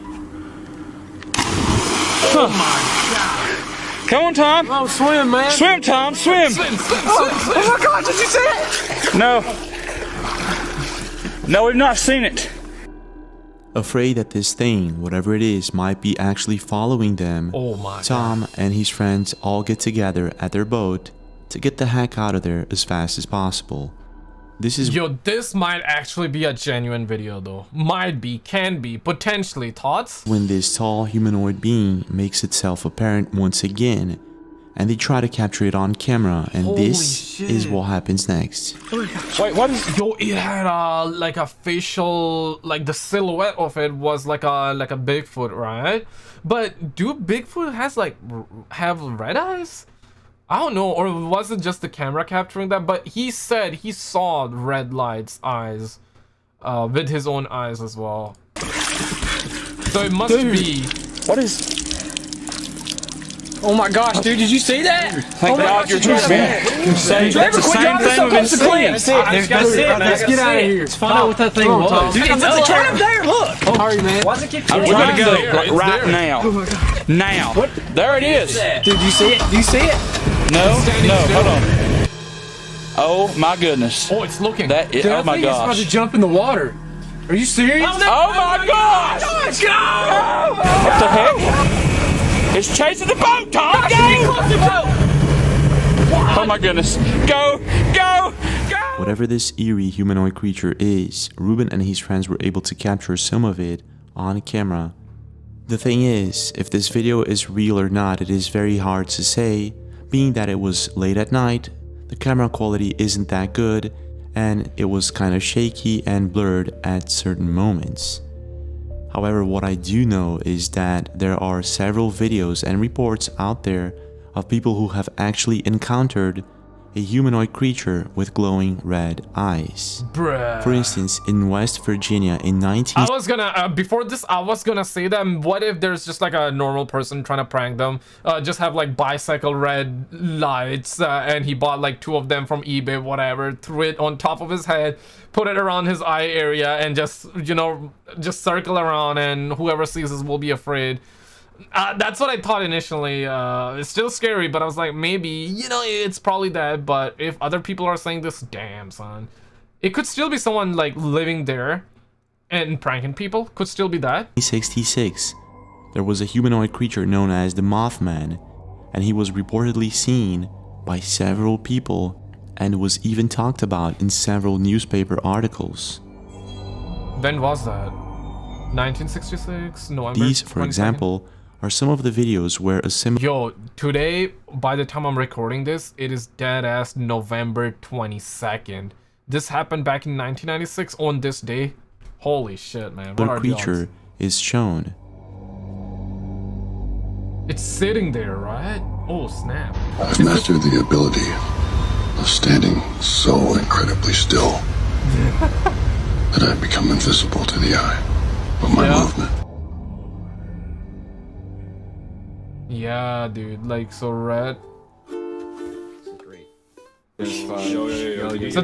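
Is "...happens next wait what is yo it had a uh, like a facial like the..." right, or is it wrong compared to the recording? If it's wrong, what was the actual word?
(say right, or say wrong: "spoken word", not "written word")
right.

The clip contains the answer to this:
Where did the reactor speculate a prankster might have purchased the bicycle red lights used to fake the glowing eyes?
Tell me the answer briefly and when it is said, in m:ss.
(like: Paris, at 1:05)
eBay, at 2:22.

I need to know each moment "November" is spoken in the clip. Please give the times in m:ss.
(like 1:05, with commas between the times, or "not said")
2:59, 3:06.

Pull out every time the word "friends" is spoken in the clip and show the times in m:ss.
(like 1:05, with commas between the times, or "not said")
0:18, 1:41.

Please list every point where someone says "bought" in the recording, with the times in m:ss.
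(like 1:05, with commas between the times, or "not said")
2:21.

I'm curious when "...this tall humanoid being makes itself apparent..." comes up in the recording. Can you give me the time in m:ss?
0:30.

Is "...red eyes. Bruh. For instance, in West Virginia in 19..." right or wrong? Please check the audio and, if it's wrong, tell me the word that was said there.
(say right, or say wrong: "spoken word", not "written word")
right.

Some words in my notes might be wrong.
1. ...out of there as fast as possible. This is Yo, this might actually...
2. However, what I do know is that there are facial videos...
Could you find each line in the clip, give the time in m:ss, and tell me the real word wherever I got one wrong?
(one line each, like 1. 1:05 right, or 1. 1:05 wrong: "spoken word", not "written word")
1. 0:22 right
2. 1:59 wrong: "several", not "facial".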